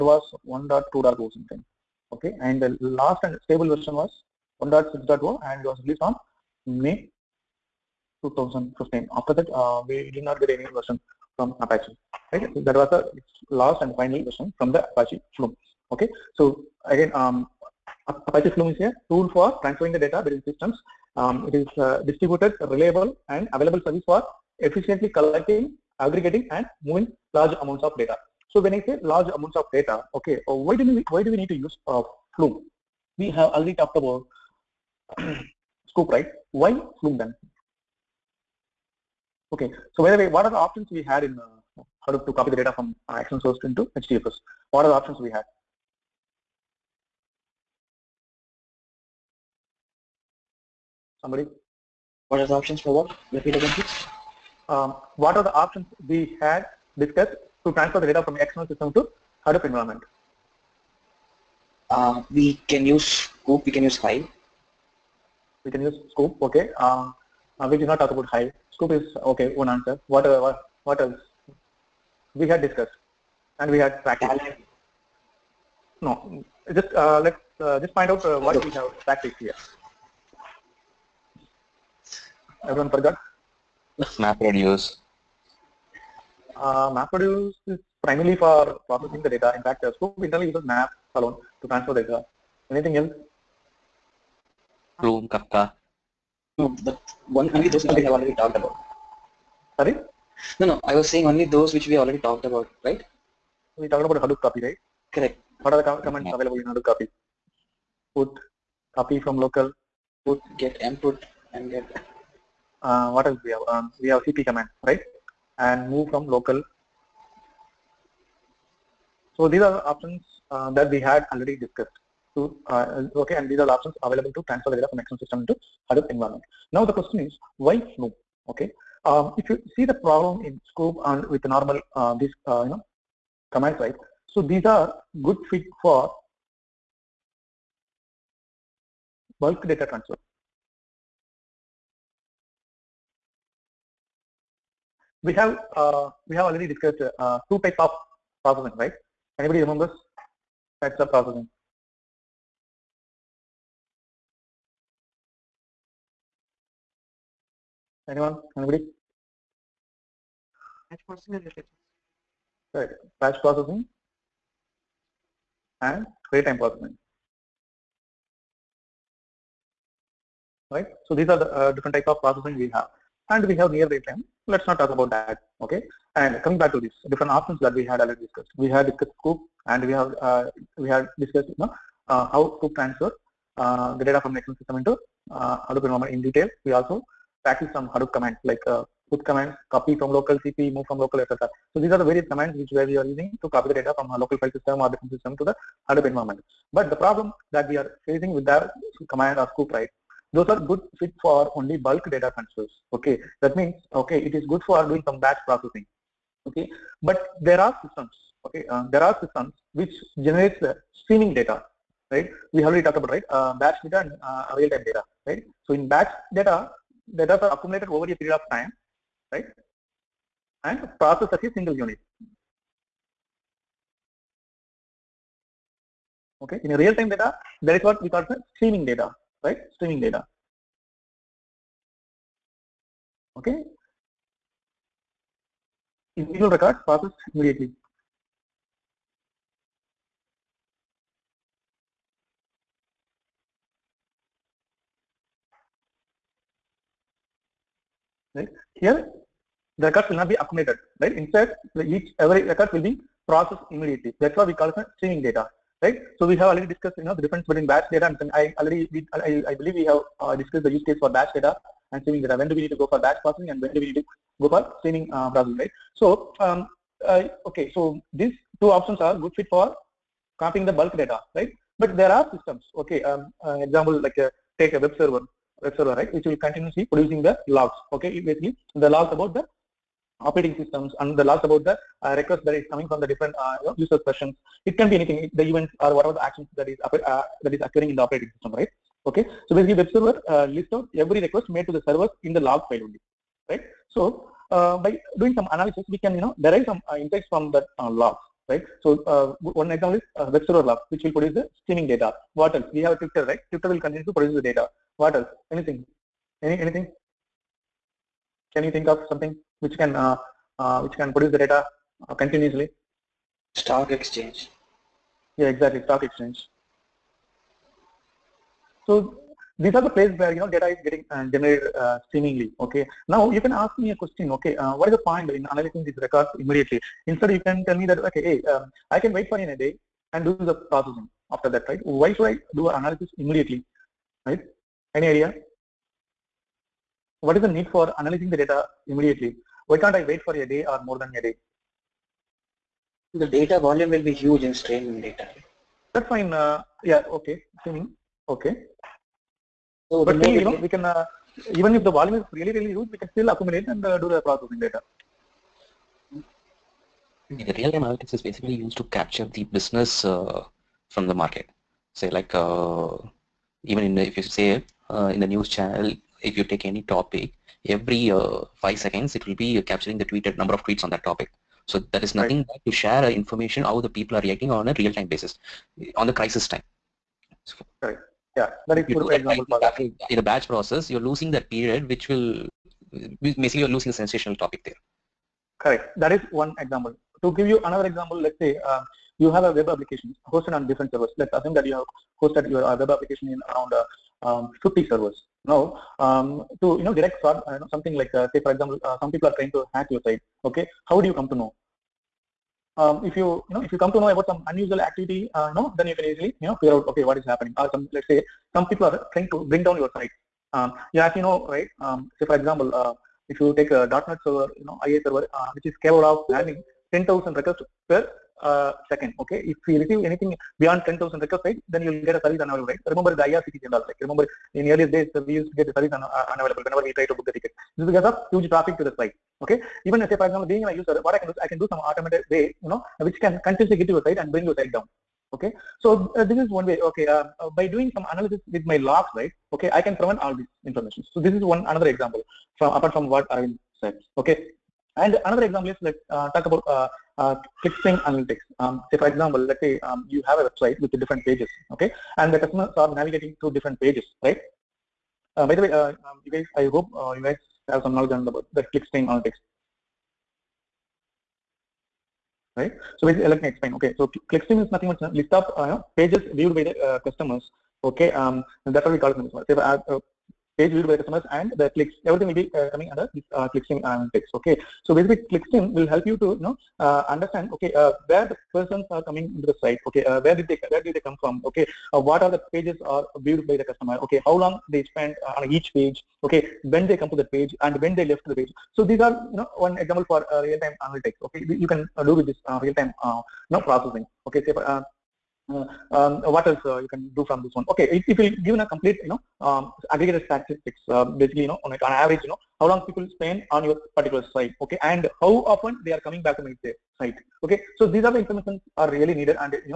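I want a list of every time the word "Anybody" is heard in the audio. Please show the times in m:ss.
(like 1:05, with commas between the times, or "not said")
2:29, 2:38.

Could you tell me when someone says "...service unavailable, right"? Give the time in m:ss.
7:02.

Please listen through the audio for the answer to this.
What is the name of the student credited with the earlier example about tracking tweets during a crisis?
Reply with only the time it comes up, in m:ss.
7:23.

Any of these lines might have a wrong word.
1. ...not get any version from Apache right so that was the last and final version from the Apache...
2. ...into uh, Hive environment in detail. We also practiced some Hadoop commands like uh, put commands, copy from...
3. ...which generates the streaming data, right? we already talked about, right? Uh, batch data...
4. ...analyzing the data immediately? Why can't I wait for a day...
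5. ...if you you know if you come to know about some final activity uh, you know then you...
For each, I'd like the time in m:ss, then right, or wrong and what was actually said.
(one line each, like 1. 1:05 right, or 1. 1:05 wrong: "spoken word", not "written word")
1. 0:10 right
2. 3:04 wrong: "Hadoop", not "Hive"
3. 3:29 right
4. 5:37 right
5. 6:43 wrong: "unusual", not "final".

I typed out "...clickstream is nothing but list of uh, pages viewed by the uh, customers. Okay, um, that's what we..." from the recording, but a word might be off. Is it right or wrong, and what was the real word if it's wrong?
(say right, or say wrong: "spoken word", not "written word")
right.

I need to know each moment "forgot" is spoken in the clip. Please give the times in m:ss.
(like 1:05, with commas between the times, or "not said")
1:22.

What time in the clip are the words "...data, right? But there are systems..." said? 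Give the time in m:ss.
4:30.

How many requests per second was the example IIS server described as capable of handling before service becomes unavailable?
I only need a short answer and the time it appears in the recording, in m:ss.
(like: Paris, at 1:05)
10,000, at 6:56.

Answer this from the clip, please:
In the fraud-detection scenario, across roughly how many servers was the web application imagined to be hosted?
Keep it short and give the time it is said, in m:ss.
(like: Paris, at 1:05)
50, at 6:34.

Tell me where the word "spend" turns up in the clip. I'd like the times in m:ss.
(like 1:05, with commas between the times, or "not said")
8:04, 8:23.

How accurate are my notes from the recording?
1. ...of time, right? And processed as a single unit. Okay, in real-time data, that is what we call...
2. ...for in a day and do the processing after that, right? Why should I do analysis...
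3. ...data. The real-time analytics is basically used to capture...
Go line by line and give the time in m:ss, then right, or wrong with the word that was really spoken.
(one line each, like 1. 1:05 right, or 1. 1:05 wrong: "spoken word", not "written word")
1. 3:38 right
2. 5:29 right
3. 5:54 right.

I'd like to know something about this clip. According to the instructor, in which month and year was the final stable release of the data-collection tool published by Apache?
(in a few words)
May 2015.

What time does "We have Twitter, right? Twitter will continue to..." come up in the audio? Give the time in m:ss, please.
5:02.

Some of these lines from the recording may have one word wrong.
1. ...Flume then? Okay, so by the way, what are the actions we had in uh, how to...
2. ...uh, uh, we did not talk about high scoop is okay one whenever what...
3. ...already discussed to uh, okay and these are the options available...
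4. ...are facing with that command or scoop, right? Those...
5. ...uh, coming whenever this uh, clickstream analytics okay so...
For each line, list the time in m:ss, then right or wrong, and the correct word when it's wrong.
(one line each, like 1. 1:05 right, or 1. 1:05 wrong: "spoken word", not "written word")
1. 0:37 wrong: "options", not "actions"
2. 1:06 wrong: "answer", not "whenever"
3. 2:01 right
4. 3:17 right
5. 7:52 wrong: "under", not "whenever".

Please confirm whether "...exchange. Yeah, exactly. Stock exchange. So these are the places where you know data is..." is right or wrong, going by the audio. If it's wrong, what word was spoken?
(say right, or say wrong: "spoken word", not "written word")
right.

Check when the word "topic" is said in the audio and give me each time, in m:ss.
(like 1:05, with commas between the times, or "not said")
6:06, 6:11, 6:24.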